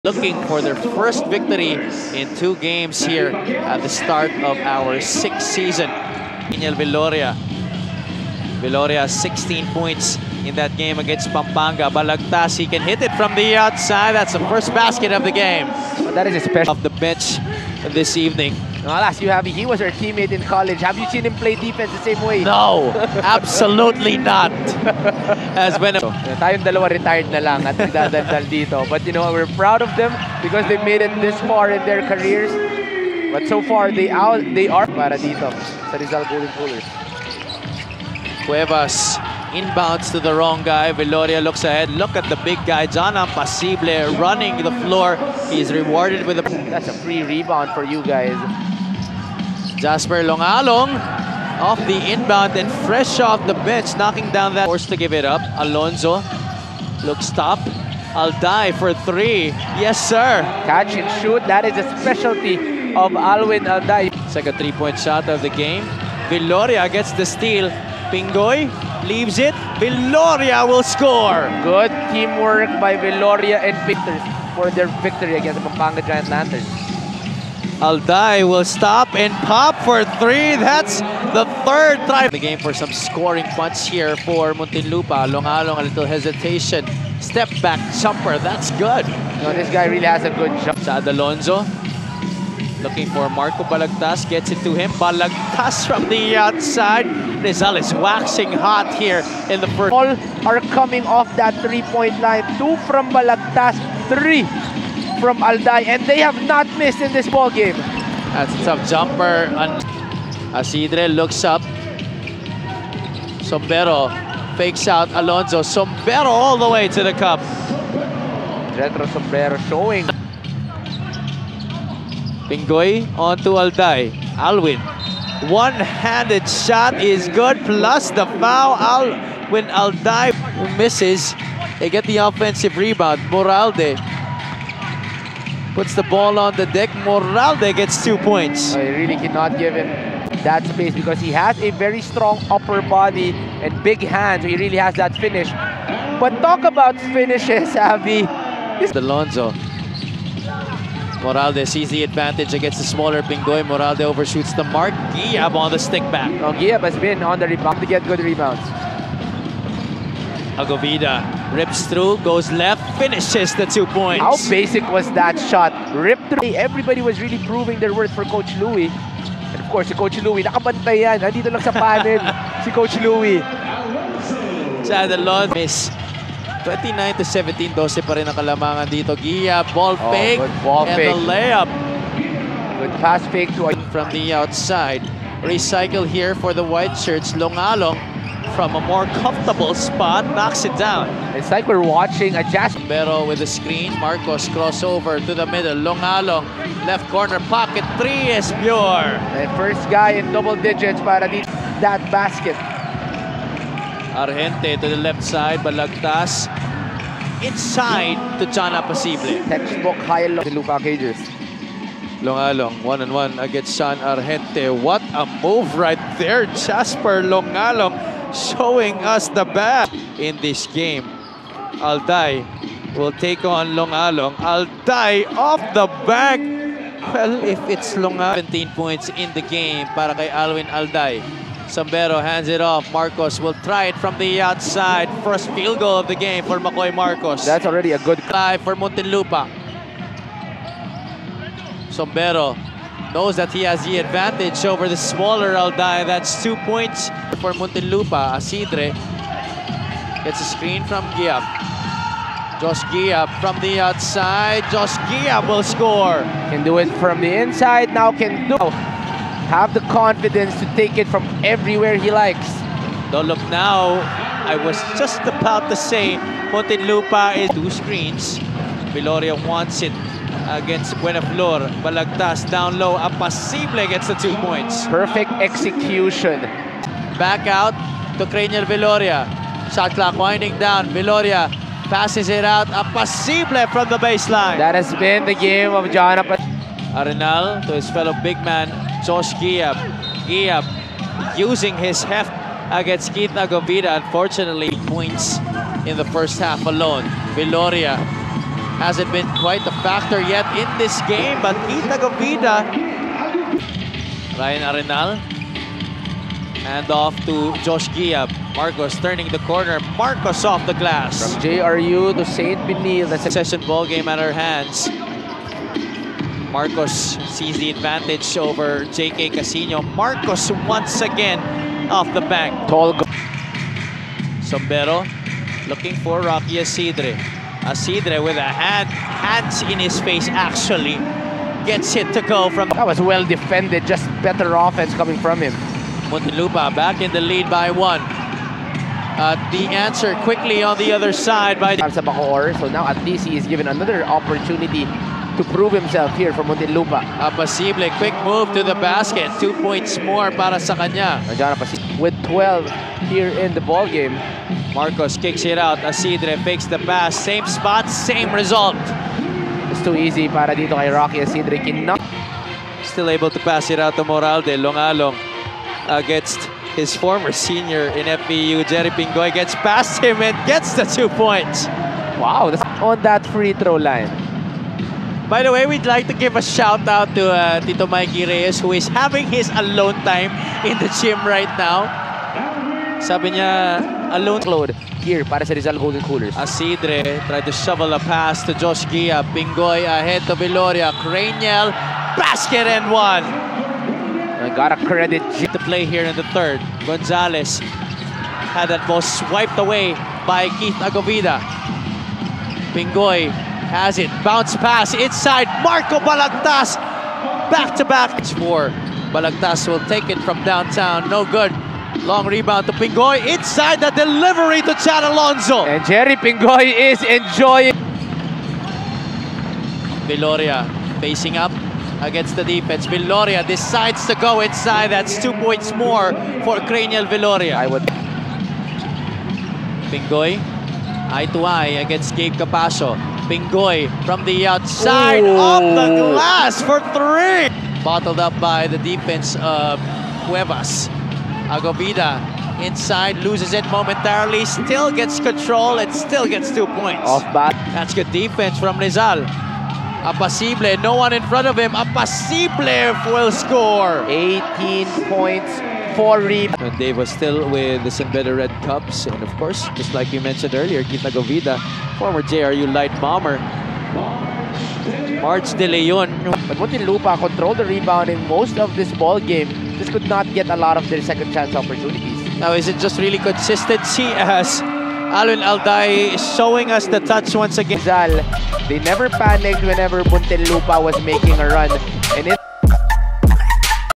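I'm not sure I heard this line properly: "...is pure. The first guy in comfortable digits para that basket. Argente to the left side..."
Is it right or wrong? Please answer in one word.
wrong.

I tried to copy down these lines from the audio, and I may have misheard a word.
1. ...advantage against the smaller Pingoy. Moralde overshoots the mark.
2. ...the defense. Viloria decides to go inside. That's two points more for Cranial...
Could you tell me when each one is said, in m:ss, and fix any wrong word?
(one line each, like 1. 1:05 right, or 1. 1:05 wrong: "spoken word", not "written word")
1. 2:32 right
2. 7:02 right.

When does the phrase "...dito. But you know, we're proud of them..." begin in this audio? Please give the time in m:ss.
0:28.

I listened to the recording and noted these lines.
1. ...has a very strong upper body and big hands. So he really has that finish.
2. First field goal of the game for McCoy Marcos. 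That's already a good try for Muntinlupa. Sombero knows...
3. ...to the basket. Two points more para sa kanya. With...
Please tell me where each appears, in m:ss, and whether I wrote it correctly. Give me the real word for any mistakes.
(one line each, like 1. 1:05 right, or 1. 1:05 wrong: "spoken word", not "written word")
1. 2:21 right
2. 3:55 right
3. 5:48 right.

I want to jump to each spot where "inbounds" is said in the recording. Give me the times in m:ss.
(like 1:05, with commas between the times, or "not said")
0:39, 0:52.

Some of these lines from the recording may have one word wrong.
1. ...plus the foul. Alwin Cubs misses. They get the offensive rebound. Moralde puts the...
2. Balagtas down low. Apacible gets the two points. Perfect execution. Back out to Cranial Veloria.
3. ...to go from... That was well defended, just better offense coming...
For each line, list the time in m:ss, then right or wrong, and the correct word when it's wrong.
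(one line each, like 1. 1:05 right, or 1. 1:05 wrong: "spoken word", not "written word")
1. 2:07 wrong: "Alday", not "Cubs"
2. 4:31 right
3. 5:32 right.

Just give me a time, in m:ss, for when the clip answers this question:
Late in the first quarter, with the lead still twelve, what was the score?
2:56.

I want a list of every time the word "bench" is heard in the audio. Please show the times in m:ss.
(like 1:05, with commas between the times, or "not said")
0:16, 0:53.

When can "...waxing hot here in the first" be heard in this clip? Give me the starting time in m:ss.
1:37.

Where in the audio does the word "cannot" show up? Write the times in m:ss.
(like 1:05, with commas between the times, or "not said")
2:19, 6:01.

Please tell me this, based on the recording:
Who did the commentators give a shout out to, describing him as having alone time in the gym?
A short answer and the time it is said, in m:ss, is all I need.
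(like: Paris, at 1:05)
Tito Mikey Reyes, at 6:17.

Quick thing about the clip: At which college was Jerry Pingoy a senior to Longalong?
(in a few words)
FEU.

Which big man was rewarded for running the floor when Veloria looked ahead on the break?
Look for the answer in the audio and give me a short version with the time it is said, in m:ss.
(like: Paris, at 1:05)
Jana Pasible, at 0:42.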